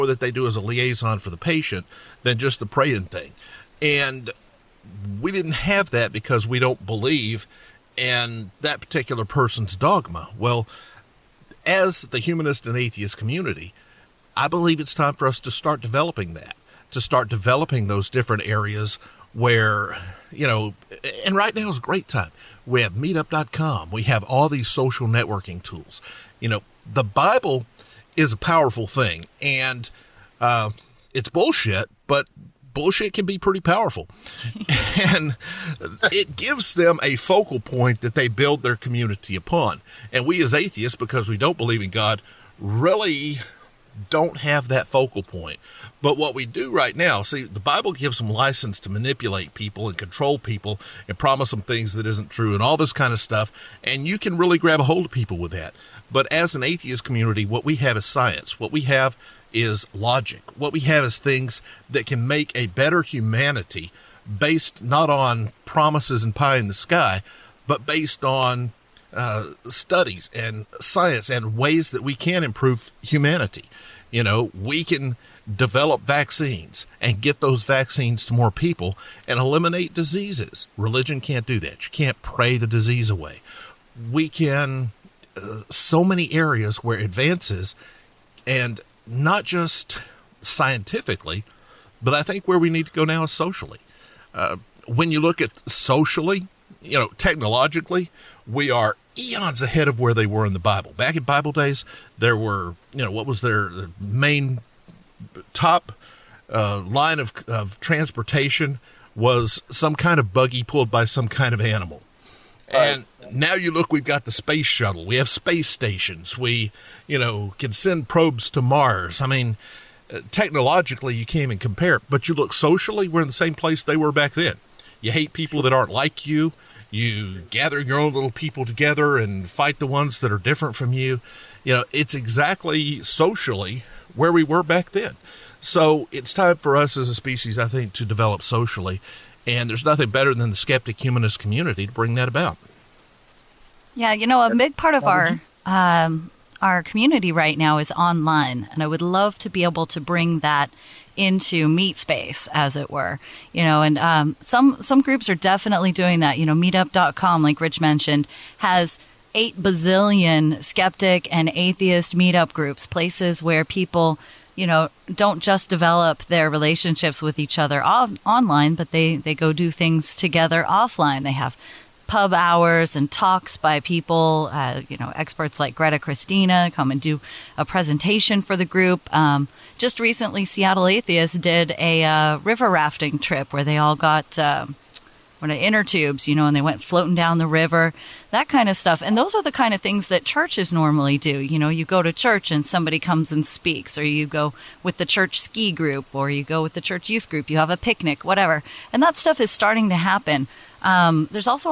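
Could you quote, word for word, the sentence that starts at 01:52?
And now you look, we've got the space shuttle.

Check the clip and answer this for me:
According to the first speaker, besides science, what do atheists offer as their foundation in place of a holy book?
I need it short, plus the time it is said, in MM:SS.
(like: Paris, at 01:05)
logic, at 00:59.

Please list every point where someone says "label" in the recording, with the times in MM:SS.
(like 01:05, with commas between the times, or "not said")
not said.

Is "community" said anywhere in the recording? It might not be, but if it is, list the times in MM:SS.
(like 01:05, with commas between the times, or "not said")
00:13, 00:38, 00:57, 02:21, 02:26.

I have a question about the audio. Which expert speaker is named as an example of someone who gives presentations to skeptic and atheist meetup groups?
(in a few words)
Greta Christina.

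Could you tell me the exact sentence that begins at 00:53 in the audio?
And you can really grab a hold of people with that.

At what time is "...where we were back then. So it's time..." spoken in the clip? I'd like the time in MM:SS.
02:14.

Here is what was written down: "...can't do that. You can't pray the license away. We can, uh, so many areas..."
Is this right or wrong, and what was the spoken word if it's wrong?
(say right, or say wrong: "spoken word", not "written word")
wrong: "disease", not "license".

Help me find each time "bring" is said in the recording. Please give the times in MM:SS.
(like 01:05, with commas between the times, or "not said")
02:21, 02:29.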